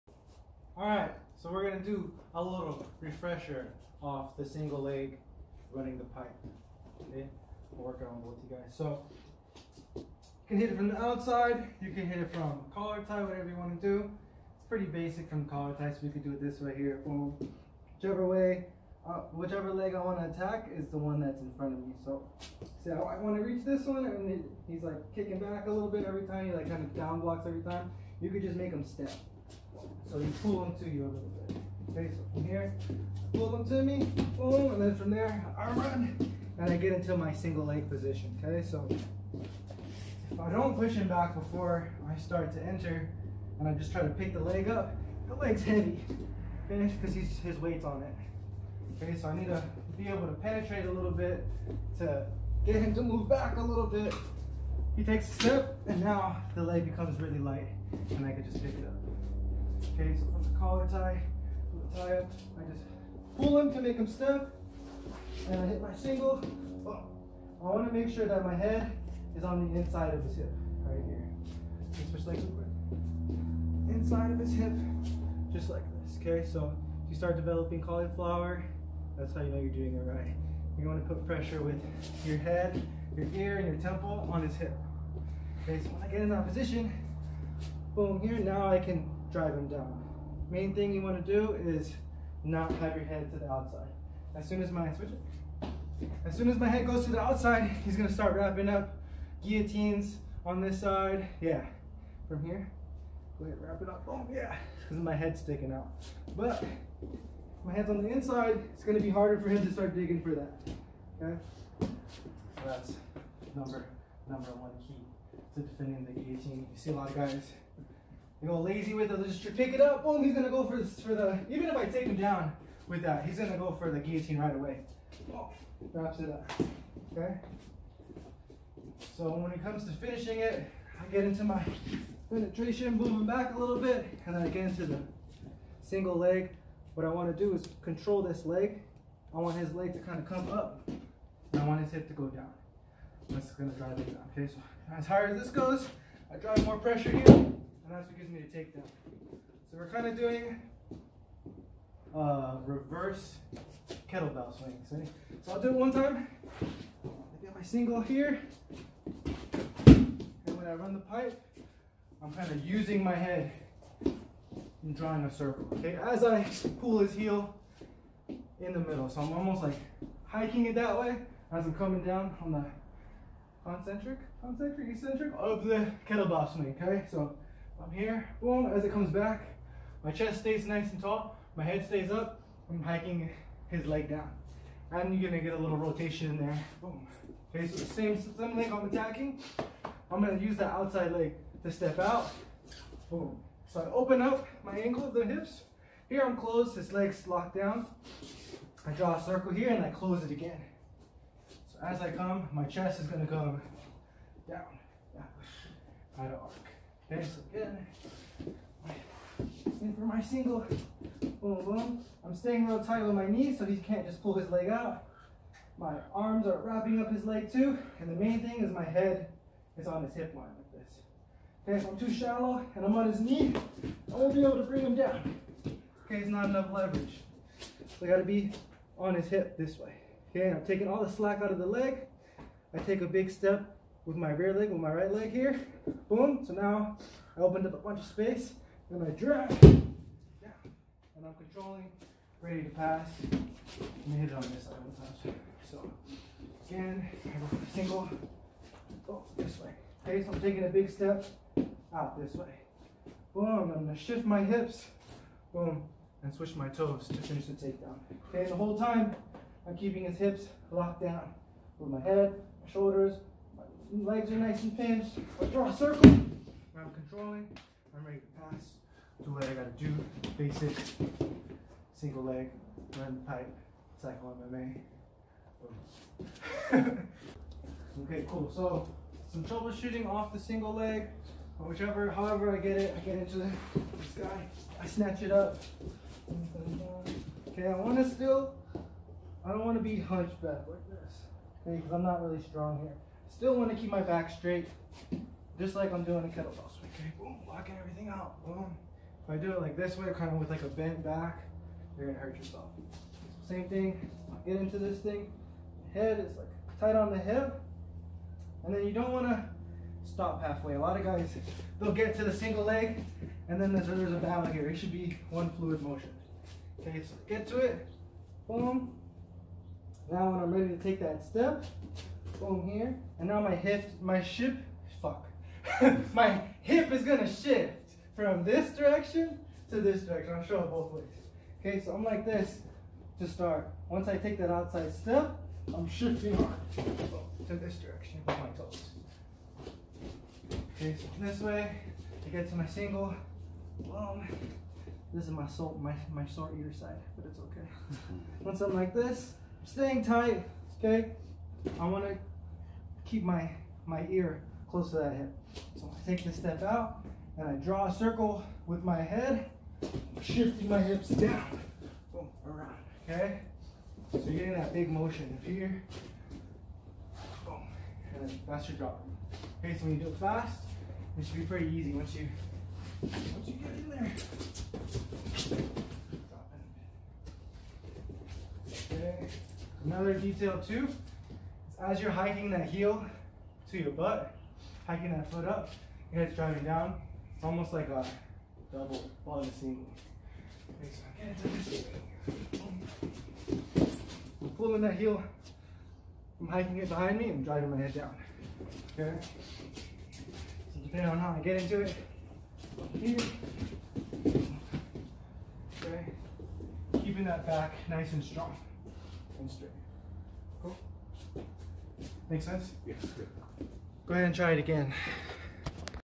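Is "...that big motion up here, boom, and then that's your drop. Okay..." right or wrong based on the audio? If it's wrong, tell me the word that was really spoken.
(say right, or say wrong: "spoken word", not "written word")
right.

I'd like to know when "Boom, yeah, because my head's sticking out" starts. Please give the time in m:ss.
1:44.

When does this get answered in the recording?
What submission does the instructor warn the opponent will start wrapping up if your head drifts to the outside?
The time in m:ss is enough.
1:39.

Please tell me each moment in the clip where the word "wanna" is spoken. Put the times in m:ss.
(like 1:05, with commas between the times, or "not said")
2:17, 5:09, 5:51.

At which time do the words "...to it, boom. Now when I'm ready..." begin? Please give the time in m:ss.
5:17.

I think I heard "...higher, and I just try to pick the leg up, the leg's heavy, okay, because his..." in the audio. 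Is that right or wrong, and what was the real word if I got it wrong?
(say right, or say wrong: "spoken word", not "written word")
wrong: "enter", not "higher".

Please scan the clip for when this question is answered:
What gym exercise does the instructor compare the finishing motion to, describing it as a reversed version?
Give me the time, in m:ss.
2:32.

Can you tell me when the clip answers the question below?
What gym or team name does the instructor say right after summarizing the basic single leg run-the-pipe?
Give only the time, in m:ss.
4:34.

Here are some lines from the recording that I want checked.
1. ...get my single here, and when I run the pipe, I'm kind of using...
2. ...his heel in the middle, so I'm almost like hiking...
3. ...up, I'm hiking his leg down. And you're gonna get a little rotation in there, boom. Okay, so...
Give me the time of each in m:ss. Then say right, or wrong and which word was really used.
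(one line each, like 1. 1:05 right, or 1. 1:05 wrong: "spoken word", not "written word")
1. 2:37 right
2. 2:46 right
3. 3:02 right.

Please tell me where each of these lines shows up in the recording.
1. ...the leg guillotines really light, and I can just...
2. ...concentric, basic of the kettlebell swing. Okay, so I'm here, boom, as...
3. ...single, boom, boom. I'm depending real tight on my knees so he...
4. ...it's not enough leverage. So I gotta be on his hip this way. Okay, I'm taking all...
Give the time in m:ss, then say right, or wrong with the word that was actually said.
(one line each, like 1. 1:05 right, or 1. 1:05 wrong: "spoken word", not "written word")
1. 0:56 wrong: "becomes", not "guillotines"
2. 2:54 wrong: "eccentric", not "basic"
3. 3:30 wrong: "staying", not "depending"
4. 3:46 right.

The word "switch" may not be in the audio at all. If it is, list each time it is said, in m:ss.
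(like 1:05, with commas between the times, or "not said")
1:12, 1:34, 4:16.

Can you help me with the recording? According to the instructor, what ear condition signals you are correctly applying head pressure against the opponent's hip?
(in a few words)
cauliflower.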